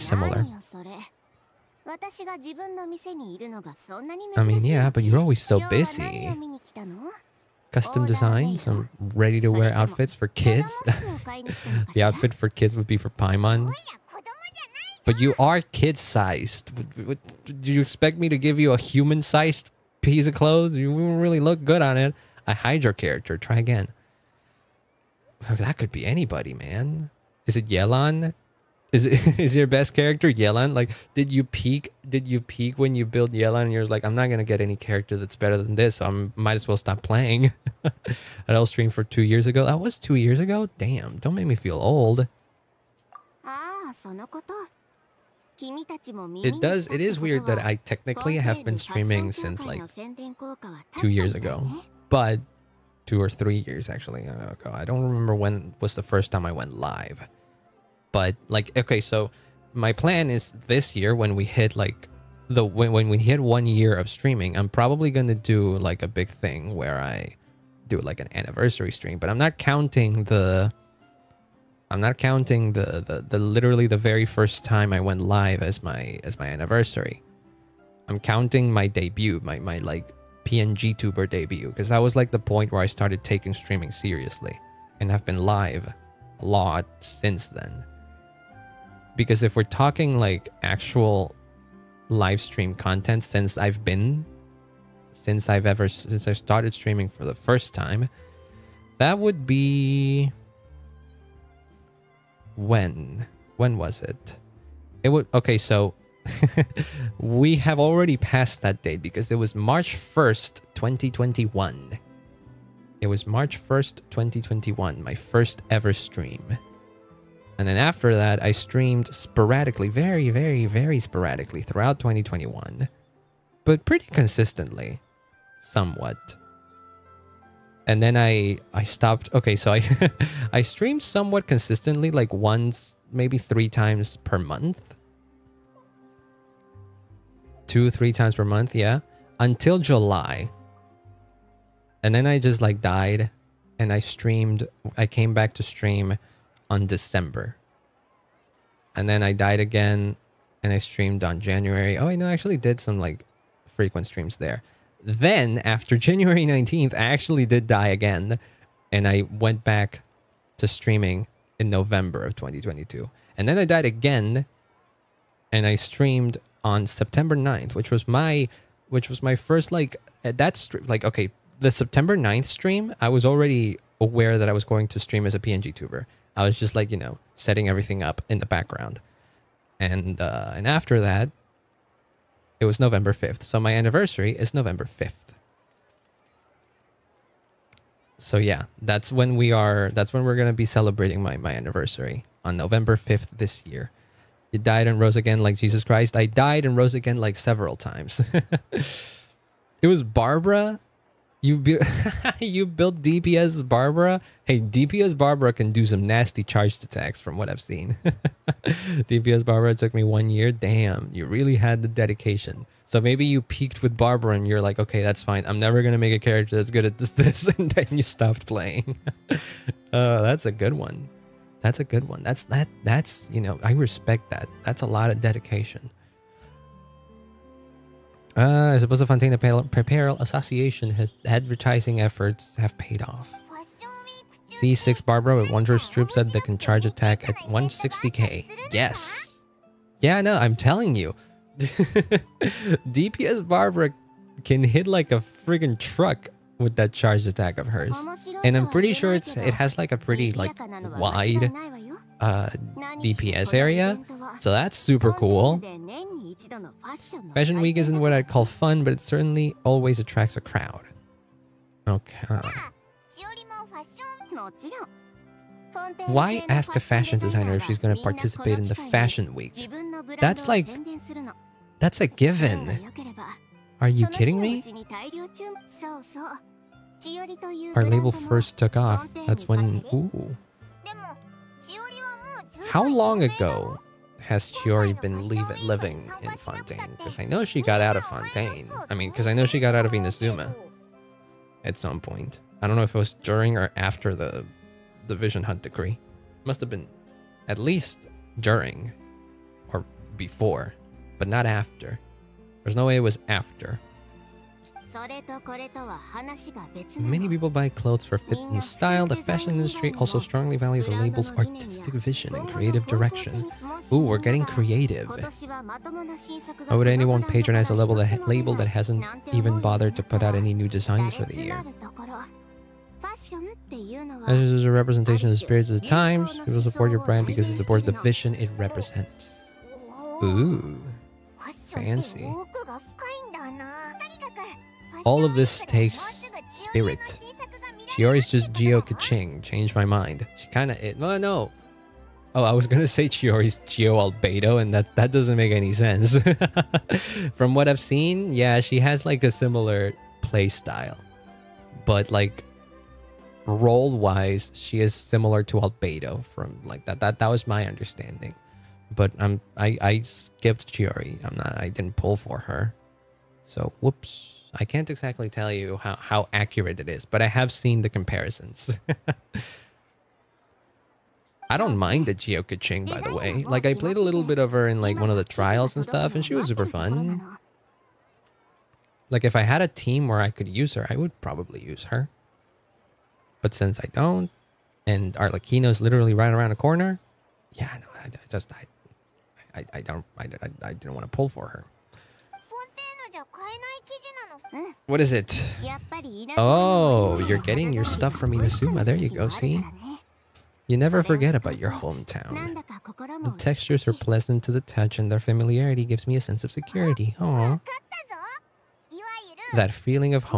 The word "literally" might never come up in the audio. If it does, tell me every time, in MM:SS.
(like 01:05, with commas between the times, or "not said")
01:13, 06:25.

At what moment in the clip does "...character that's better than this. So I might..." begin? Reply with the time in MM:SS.
00:34.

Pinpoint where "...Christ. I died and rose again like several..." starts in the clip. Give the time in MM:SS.
03:15.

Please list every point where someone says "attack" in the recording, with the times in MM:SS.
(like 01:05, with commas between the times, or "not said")
03:26, 03:56, 04:07.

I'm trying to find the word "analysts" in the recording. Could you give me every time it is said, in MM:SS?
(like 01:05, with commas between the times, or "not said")
not said.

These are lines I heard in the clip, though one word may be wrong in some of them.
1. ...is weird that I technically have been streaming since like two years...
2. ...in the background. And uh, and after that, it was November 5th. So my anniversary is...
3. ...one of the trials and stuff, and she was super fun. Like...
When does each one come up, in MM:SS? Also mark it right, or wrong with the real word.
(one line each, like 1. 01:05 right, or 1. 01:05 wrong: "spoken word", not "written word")
1. 00:47 right
2. 02:58 right
3. 06:14 right.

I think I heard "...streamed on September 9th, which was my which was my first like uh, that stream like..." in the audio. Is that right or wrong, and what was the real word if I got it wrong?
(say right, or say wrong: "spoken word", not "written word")
right.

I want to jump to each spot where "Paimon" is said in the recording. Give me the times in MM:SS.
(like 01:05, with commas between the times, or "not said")
00:13.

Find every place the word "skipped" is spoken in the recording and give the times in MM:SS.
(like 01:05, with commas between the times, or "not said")
06:00.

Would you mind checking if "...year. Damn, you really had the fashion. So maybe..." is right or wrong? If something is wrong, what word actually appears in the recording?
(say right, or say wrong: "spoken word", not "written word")
wrong: "dedication", not "fashion".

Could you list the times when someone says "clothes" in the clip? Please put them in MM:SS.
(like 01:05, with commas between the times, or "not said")
00:20, 05:07.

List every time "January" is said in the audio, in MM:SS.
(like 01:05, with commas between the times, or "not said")
02:31, 02:36.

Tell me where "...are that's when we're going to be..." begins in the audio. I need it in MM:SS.
03:09.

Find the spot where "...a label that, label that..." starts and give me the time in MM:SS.
05:17.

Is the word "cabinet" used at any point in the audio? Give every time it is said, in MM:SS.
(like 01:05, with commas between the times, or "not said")
not said.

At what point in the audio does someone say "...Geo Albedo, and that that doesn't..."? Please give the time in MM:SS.
05:43.